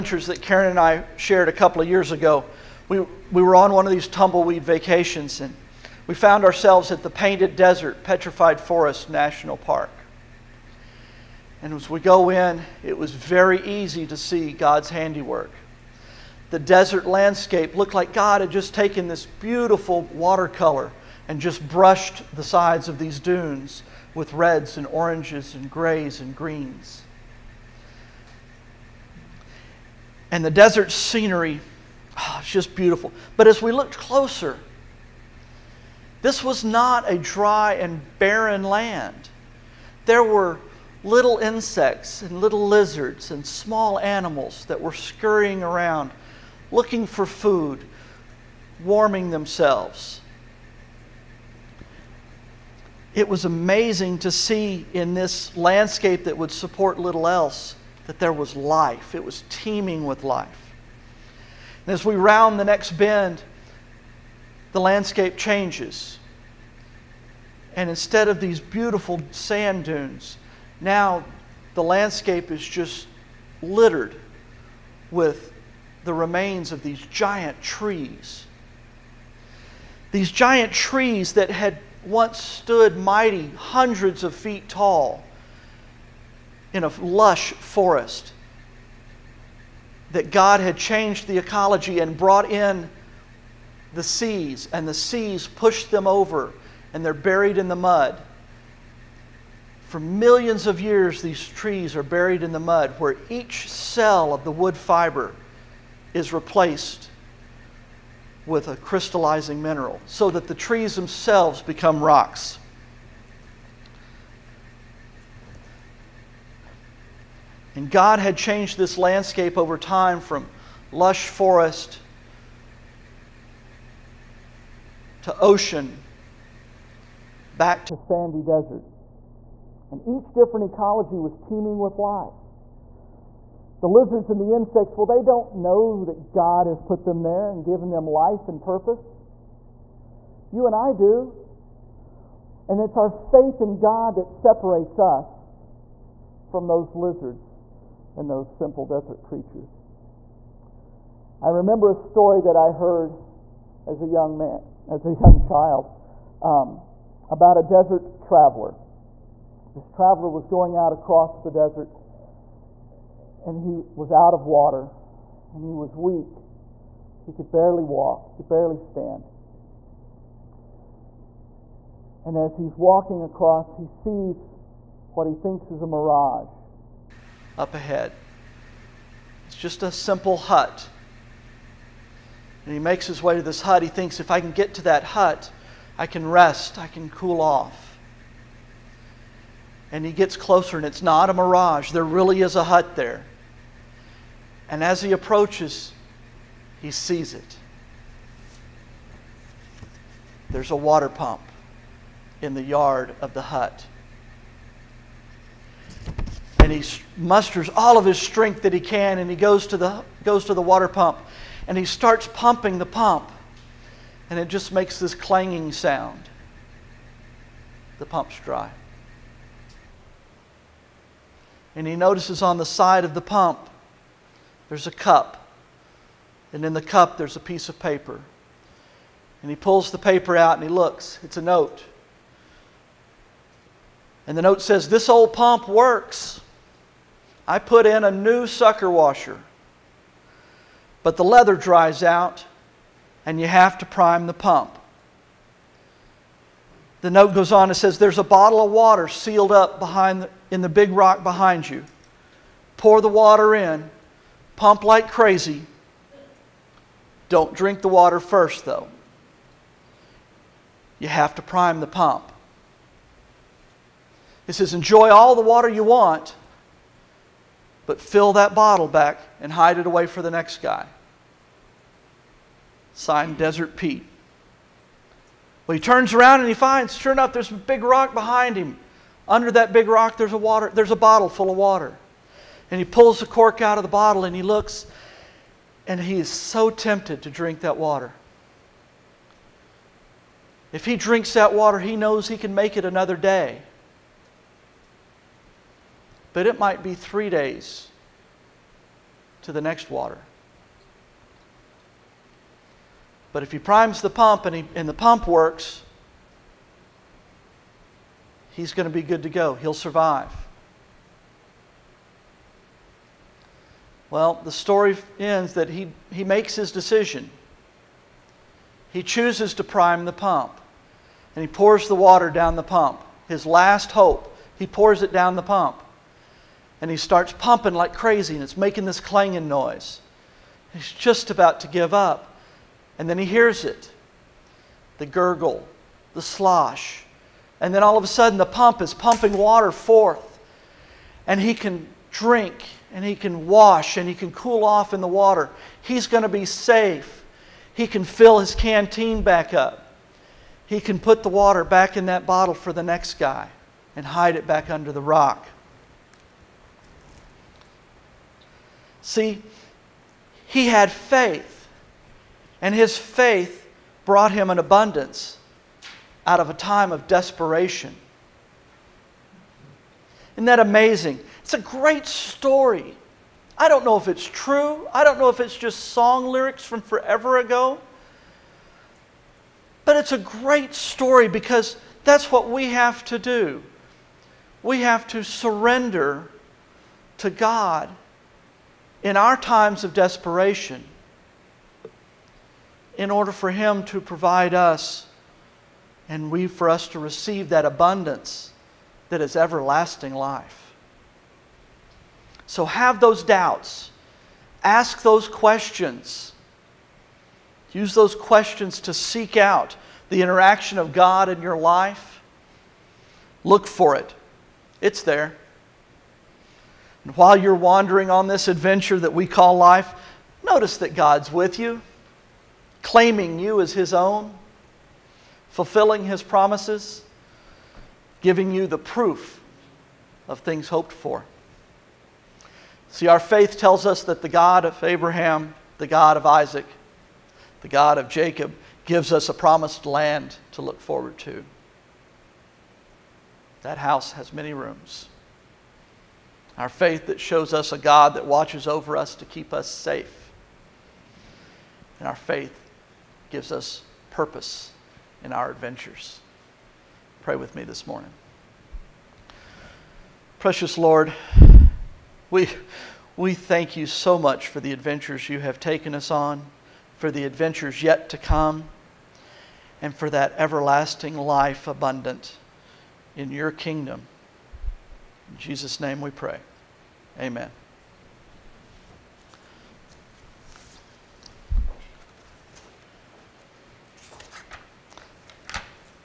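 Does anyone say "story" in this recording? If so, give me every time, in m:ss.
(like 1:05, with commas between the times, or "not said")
2:31, 5:14, 6:12, 6:20.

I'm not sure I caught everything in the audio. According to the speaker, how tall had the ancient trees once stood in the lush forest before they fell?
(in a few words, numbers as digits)
hundreds of feet tall.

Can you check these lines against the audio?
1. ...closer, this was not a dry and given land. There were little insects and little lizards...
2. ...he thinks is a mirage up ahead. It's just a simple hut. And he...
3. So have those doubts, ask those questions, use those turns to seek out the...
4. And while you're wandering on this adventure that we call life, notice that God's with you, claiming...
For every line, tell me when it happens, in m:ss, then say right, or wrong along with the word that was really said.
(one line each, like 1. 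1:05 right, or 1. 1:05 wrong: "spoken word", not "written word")
1. 0:33 wrong: "barren", not "given"
2. 2:55 right
3. 6:42 wrong: "questions", not "turns"
4. 6:57 right.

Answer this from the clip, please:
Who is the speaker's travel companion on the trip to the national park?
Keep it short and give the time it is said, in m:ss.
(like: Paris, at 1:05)
Karen, at 0:00.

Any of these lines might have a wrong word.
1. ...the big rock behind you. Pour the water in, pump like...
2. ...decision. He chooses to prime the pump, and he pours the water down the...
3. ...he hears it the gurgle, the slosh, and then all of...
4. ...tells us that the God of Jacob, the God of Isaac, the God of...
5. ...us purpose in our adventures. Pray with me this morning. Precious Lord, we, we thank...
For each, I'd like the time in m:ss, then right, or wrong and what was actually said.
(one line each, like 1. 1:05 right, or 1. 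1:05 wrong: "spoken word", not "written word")
1. 4:10 right
2. 5:16 right
3. 5:33 right
4. 7:13 wrong: "Abraham", not "Jacob"
5. 7:33 right.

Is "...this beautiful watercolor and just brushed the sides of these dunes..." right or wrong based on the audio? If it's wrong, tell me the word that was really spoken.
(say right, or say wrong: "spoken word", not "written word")
right.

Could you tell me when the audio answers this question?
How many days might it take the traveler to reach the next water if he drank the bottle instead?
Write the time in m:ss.
4:56.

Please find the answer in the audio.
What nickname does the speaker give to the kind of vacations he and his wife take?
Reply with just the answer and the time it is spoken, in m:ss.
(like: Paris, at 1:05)
tumbleweed vacations, at 0:04.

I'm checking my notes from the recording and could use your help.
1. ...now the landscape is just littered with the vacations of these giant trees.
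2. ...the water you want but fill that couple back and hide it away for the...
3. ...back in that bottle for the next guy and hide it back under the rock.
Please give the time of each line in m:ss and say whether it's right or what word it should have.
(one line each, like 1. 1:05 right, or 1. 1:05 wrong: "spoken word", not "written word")
1. 1:10 wrong: "remains", not "vacations"
2. 4:25 wrong: "bottle", not "couple"
3. 5:51 right.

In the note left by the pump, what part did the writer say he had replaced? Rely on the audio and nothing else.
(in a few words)
sucker washer.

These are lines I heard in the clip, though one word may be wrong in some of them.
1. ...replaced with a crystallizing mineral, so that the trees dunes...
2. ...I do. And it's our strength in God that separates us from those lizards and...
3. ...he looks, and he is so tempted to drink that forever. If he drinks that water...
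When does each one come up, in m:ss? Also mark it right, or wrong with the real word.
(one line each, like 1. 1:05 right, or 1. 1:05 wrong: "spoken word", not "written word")
1. 1:46 wrong: "themselves", not "dunes"
2. 2:20 wrong: "faith", not "strength"
3. 4:44 wrong: "water", not "forever".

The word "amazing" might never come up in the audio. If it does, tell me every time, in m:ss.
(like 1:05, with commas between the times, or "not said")
0:53, 6:10.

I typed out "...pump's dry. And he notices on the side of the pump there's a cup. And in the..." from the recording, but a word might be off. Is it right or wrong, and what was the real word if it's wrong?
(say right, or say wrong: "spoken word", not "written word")
right.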